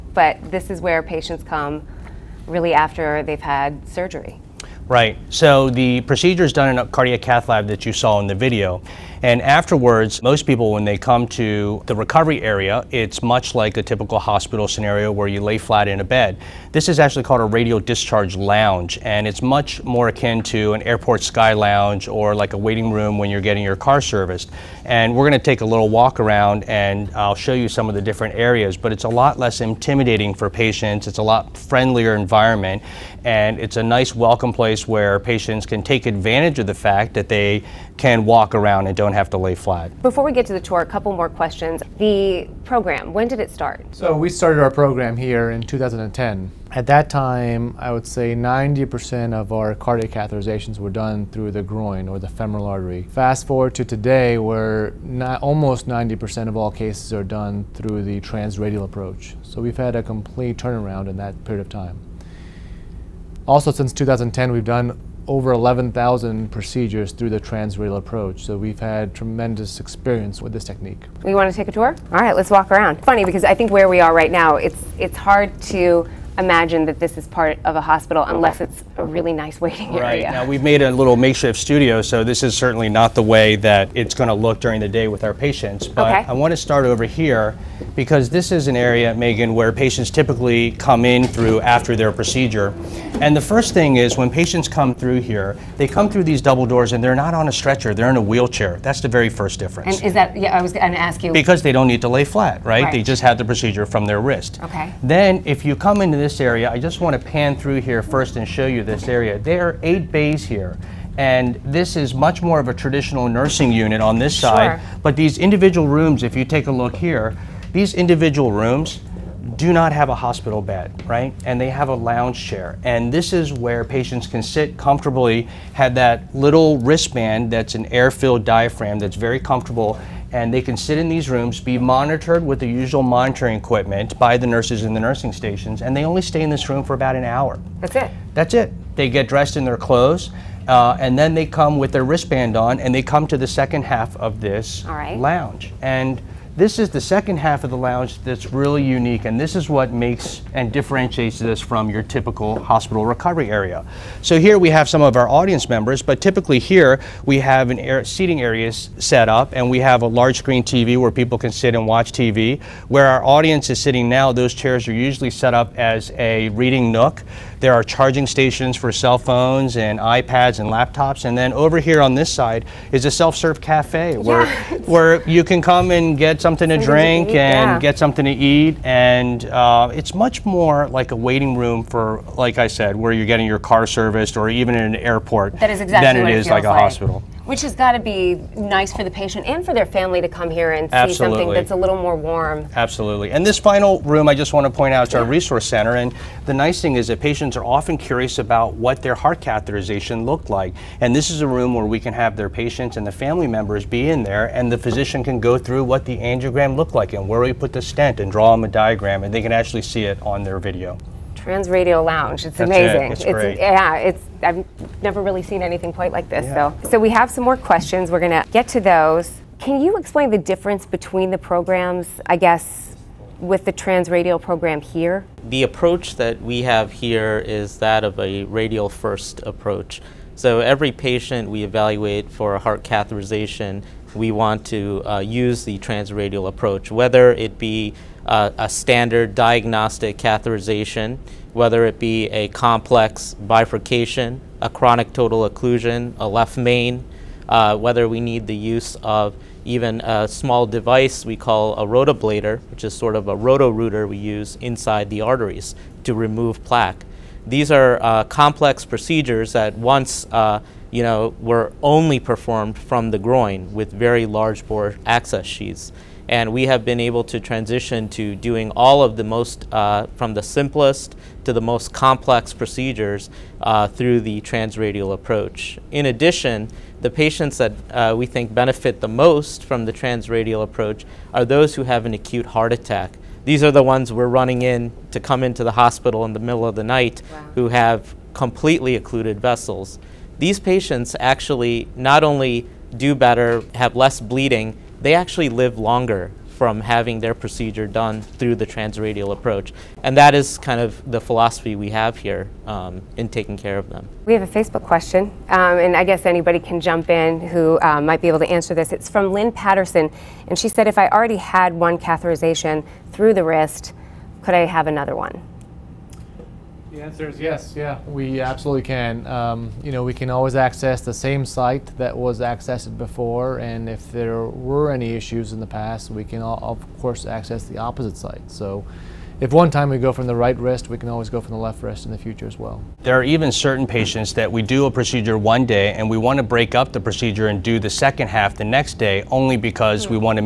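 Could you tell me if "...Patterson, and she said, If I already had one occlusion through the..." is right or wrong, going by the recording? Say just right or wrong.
wrong.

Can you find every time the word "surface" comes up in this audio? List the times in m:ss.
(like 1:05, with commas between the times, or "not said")
not said.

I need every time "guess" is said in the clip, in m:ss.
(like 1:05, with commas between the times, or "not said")
3:42, 5:06.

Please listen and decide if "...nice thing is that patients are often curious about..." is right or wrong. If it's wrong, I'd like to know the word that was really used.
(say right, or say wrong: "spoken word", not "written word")
right.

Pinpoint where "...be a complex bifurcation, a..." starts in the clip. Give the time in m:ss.
4:01.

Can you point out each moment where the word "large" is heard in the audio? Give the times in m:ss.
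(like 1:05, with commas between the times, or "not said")
2:40, 4:24.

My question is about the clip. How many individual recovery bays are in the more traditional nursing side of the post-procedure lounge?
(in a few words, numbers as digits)
8.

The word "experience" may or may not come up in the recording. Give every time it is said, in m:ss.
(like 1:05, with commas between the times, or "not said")
1:09.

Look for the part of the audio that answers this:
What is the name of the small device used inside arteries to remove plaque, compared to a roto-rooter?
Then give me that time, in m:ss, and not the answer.
4:11.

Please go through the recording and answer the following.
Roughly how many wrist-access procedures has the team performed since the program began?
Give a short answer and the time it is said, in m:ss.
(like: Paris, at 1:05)
11,000, at 1:05.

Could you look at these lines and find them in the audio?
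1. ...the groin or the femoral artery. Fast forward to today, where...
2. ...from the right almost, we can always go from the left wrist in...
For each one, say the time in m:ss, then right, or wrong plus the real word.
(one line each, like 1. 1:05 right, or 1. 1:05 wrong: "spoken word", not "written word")
1. 0:51 right
2. 5:30 wrong: "wrist", not "almost".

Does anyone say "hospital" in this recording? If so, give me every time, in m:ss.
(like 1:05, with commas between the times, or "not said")
0:14, 1:17, 2:00, 2:32, 3:06, 4:45.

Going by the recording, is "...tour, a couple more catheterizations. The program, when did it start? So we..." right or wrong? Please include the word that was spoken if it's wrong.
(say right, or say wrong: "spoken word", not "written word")
wrong: "questions", not "catheterizations".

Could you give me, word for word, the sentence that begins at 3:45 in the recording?
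The approach that we have here is that of a radial first approach.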